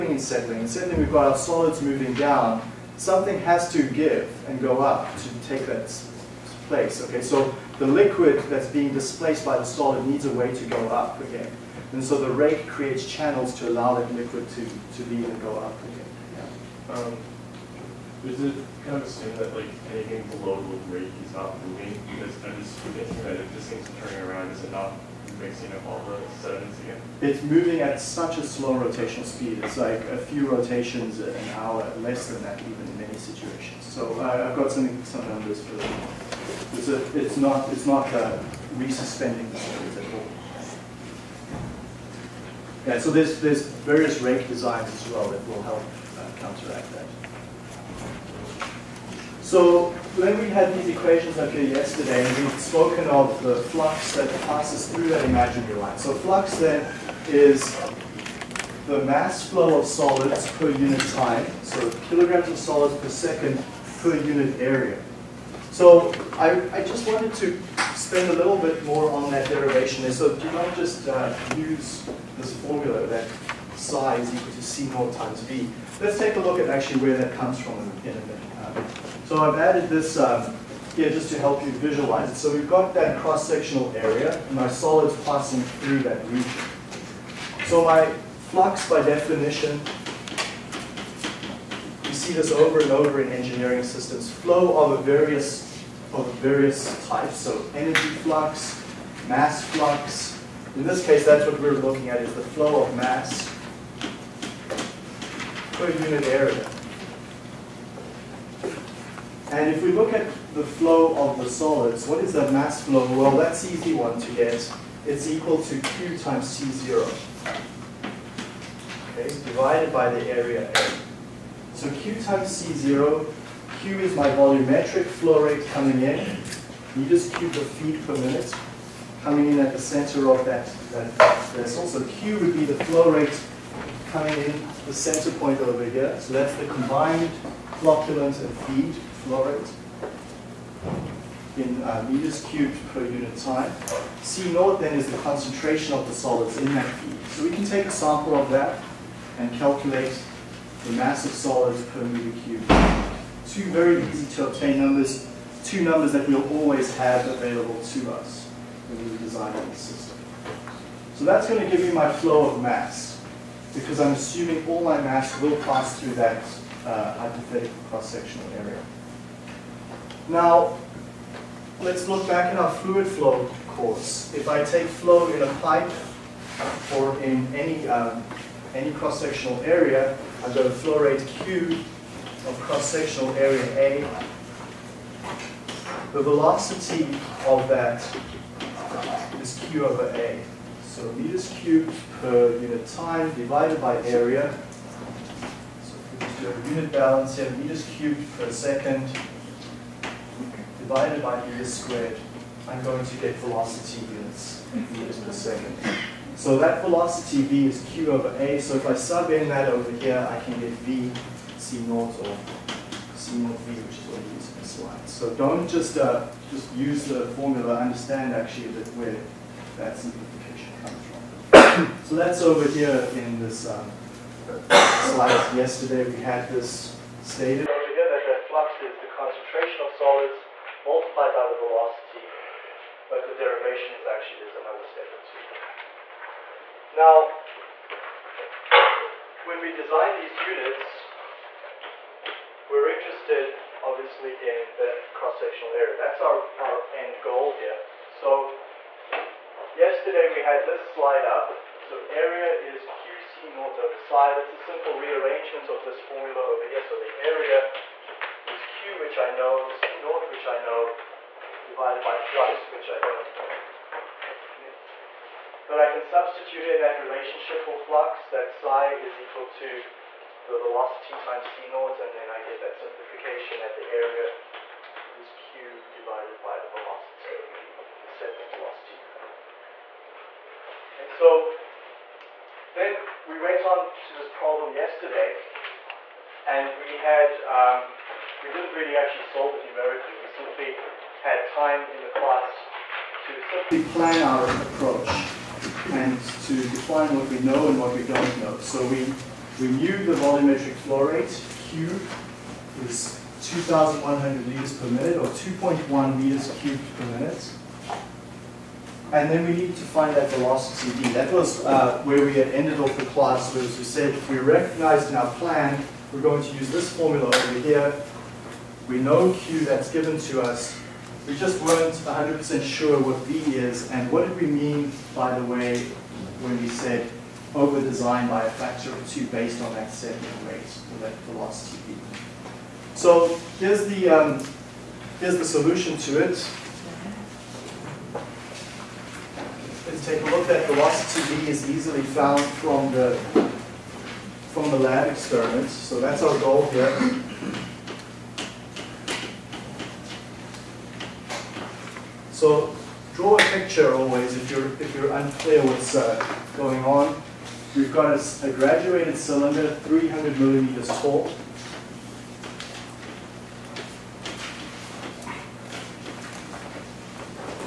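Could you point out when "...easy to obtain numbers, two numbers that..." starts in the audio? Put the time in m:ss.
2:34.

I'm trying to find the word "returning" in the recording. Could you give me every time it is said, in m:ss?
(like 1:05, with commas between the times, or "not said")
not said.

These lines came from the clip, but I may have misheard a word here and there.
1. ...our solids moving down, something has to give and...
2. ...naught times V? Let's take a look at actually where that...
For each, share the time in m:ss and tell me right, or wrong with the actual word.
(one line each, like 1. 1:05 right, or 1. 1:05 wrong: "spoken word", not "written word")
1. 0:01 right
2. 1:14 right.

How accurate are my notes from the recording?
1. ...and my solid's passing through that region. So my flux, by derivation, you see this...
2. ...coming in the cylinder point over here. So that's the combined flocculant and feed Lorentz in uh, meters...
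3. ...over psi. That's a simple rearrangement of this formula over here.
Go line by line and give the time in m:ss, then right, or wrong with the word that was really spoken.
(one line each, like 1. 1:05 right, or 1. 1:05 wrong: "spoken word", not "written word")
1. 1:24 wrong: "definition", not "derivation"
2. 2:14 wrong: "center", not "cylinder"
3. 4:13 right.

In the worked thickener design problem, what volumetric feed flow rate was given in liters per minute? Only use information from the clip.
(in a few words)
2,100 liters per minute.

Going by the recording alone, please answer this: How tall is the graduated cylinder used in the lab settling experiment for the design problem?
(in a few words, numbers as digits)
300 millimeters.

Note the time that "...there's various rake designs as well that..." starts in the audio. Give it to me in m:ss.
0:43.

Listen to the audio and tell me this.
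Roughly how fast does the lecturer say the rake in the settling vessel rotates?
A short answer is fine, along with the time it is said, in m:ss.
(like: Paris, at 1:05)
A few rotations an hour, at 0:30.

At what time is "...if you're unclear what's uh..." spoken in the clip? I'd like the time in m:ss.
5:54.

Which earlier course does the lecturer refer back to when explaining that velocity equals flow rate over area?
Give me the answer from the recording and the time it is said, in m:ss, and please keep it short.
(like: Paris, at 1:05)
Fluid flow course, at 2:52.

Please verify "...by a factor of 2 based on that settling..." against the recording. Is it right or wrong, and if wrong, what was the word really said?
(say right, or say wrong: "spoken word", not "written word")
right.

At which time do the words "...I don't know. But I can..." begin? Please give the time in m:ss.
4:22.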